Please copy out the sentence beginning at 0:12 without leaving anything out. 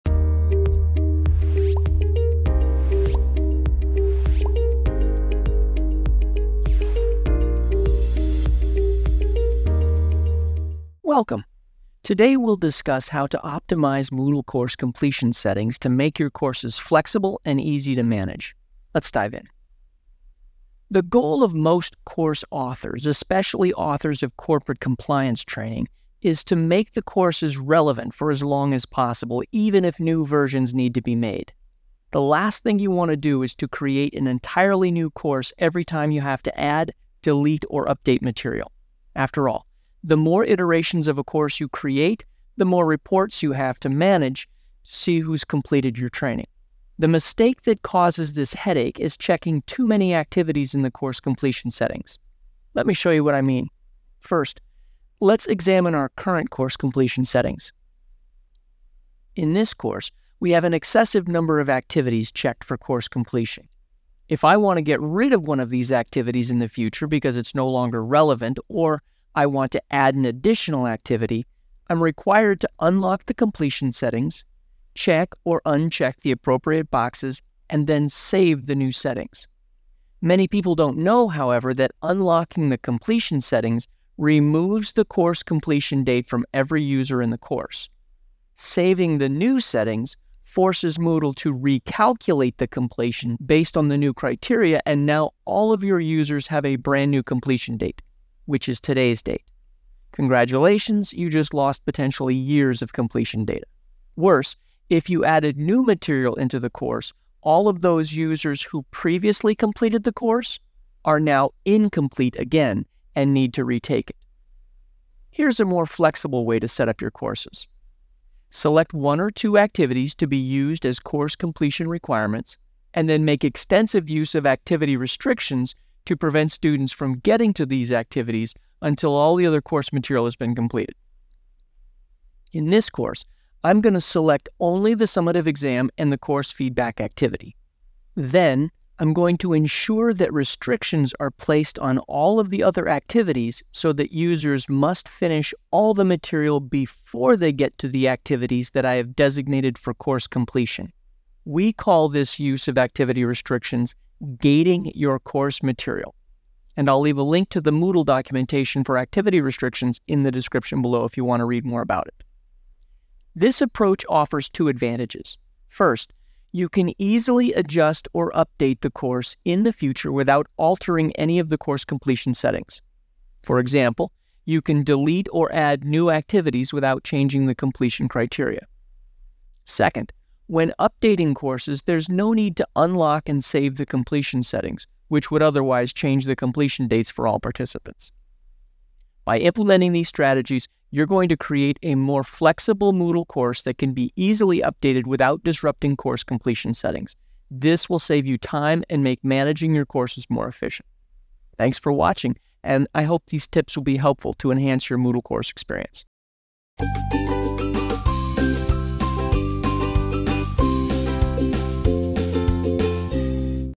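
Today we'll discuss how to optimize Moodle course completion settings to make your courses flexible and easy to manage.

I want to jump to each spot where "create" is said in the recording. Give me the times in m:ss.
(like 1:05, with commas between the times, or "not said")
0:33, 0:41, 3:11.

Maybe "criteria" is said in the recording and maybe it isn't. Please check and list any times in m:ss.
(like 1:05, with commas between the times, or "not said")
1:34, 2:58.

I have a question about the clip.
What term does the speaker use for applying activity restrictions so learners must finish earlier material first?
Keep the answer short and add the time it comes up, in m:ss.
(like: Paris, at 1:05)
Gating, at 2:34.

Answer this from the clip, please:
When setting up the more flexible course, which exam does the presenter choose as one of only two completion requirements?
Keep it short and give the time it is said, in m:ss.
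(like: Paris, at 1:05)
The summative exam, at 2:15.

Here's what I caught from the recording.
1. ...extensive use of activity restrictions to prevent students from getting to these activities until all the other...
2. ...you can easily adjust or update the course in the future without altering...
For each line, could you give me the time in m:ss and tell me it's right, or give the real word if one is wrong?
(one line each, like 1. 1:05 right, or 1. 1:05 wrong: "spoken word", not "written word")
1. 2:03 right
2. 2:46 right.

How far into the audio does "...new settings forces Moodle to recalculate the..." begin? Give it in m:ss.
1:29.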